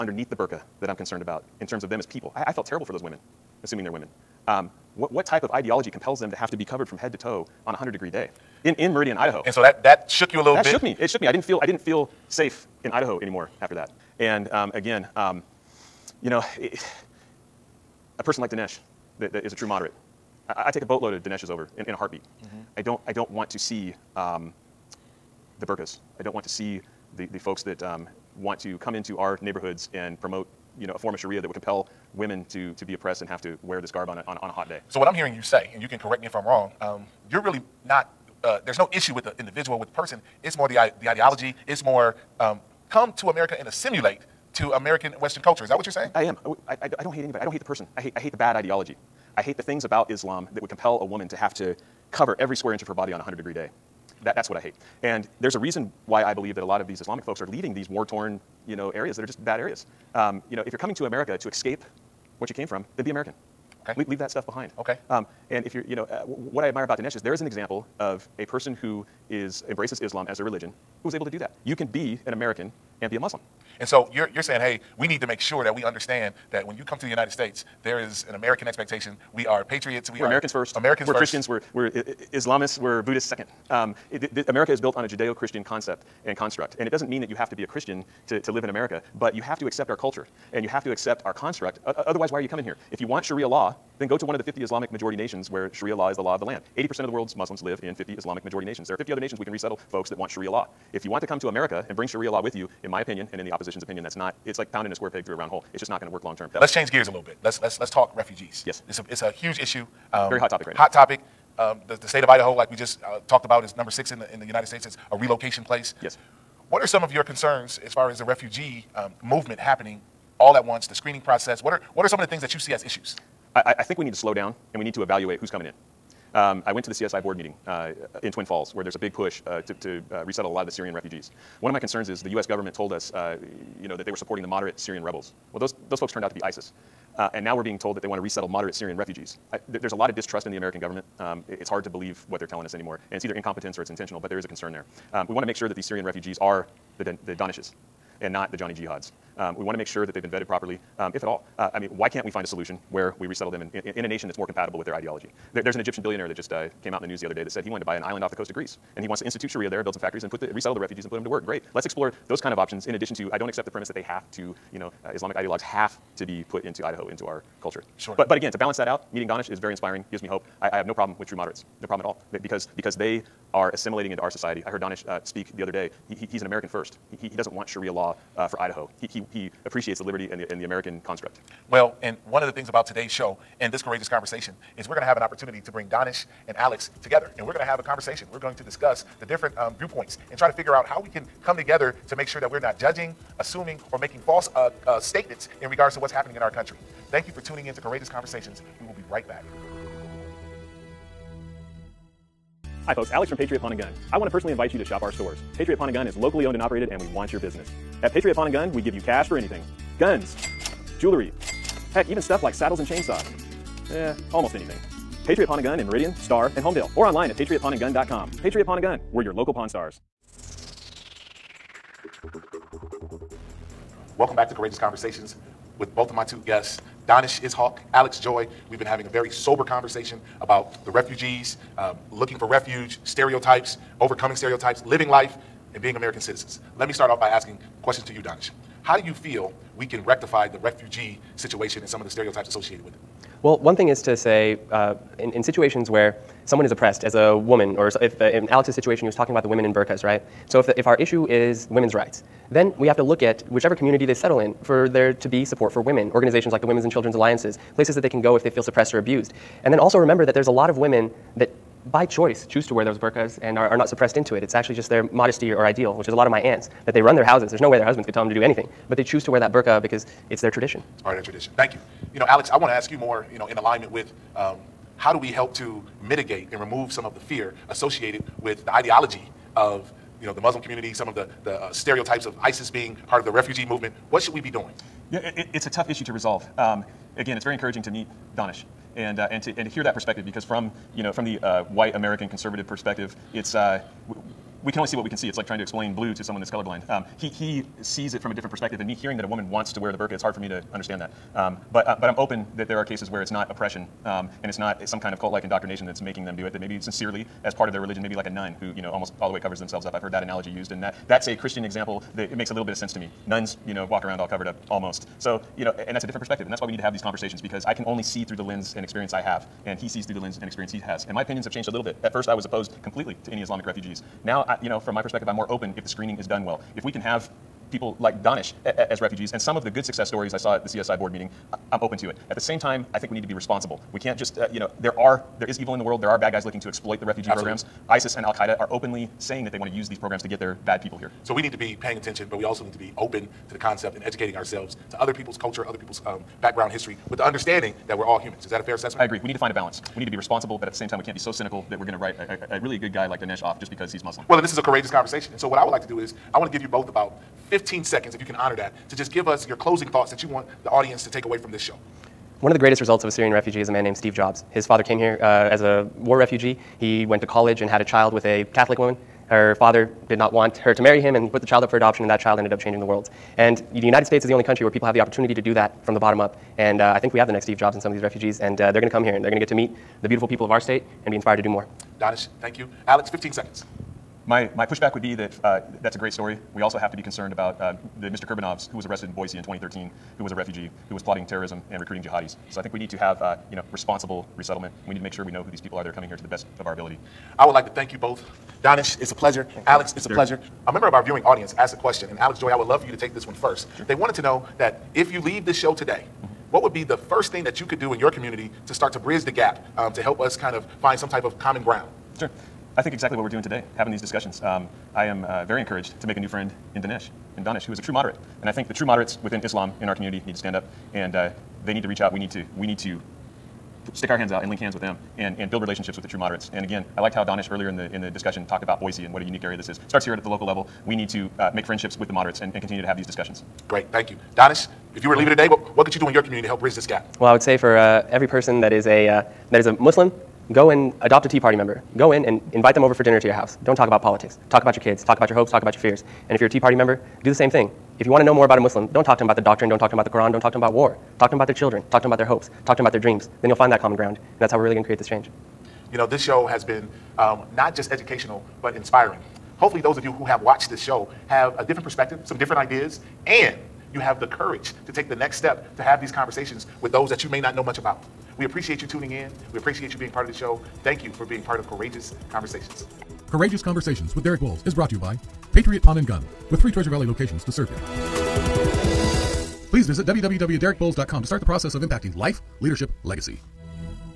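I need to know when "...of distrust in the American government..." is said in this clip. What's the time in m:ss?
2:20.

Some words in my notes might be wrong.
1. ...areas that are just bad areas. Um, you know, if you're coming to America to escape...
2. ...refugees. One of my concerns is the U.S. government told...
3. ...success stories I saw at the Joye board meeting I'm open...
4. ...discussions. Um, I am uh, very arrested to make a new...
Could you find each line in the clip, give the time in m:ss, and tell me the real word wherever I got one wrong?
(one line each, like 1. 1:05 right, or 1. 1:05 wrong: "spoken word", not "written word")
1. 0:58 right
2. 2:10 right
3. 5:29 wrong: "CSI", not "Joye"
4. 6:54 wrong: "encouraged", not "arrested".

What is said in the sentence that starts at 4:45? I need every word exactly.
Yeah, it, it, it's a tough issue to resolve.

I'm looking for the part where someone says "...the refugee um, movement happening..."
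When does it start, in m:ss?
1:58.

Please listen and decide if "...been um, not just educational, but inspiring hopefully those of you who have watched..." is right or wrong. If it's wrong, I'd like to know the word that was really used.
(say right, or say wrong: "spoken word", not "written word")
right.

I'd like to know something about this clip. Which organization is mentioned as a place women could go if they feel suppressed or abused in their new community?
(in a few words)
Women's and Children's Alliances.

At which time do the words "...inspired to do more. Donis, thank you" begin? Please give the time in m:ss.
6:21.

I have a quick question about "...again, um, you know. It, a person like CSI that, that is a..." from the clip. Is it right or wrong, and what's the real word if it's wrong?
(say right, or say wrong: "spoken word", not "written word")
wrong: "Dinesh", not "CSI".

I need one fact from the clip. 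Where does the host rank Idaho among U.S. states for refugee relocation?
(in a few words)
Number six.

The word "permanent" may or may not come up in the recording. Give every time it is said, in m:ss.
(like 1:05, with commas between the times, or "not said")
not said.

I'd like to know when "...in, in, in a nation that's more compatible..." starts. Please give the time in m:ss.
2:33.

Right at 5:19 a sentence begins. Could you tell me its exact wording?
And he sees through the lens and experience he has.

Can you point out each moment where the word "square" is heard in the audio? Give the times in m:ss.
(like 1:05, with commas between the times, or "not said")
0:52, 1:44.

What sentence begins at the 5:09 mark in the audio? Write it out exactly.
I've heard that analogy used, and that that's a Christian example that it makes a little bit of sense to me.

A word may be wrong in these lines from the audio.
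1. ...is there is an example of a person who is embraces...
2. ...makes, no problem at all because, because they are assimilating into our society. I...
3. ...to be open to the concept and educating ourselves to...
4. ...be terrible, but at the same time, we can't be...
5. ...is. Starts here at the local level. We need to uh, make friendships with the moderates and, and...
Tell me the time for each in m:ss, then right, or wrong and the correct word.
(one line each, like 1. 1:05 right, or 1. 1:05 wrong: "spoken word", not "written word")
1. 1:07 right
2. 2:51 wrong: "moderates", not "makes"
3. 5:42 right
4. 5:50 wrong: "responsible", not "terrible"
5. 7:09 right.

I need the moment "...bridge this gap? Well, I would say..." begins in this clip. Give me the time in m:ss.
7:16.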